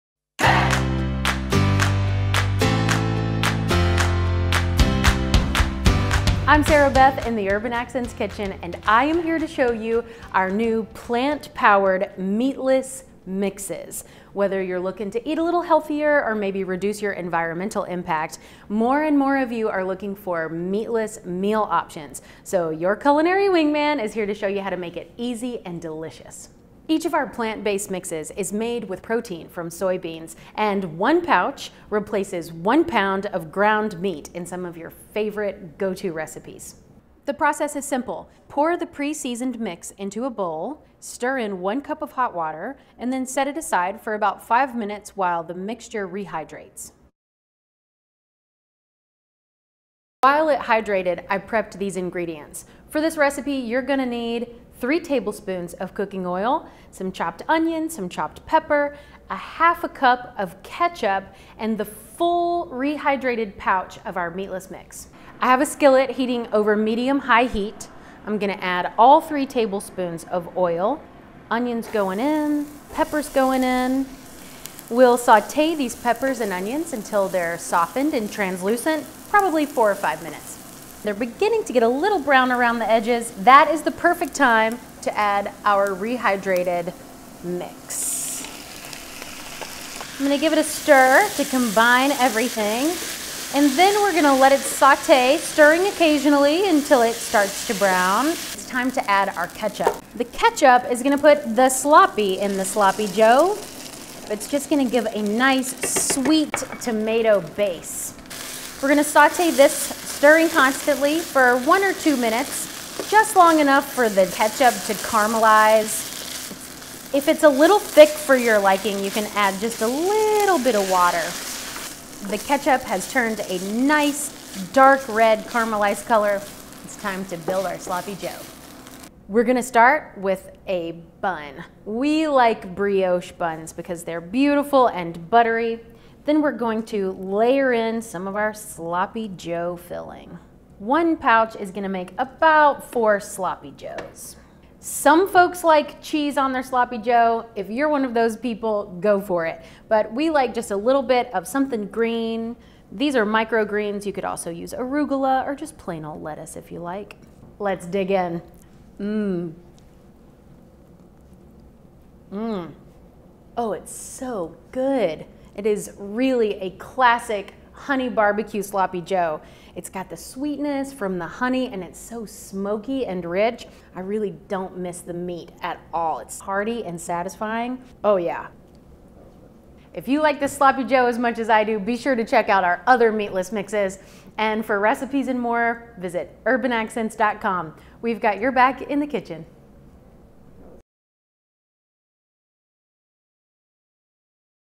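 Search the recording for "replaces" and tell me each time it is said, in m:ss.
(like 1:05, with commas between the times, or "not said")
0:31.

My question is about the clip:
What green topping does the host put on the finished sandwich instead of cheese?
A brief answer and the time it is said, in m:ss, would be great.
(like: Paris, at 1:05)
microgreens, at 2:33.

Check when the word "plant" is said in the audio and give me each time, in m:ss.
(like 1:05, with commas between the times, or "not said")
0:10, 0:27.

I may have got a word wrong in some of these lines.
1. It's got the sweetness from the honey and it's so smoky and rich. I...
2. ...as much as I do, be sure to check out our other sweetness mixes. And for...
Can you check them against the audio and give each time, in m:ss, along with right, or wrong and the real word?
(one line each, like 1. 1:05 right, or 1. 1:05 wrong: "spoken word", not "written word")
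1. 2:49 right
2. 3:01 wrong: "meatless", not "sweetness".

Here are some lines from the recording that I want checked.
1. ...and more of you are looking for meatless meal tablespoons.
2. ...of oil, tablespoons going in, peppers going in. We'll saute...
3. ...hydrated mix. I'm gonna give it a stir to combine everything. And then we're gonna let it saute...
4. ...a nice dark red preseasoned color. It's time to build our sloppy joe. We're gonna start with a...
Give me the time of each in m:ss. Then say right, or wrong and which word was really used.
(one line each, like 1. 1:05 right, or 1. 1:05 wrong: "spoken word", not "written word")
1. 0:19 wrong: "options", not "tablespoons"
2. 1:10 wrong: "onions", not "tablespoons"
3. 1:25 wrong: "rehydrated", not "hydrated"
4. 2:03 wrong: "caramelized", not "preseasoned".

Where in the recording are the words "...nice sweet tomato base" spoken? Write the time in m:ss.
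1:45.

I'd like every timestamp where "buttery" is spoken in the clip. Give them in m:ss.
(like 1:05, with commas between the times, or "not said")
2:15.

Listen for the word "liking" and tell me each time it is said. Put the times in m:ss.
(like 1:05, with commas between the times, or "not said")
1:58.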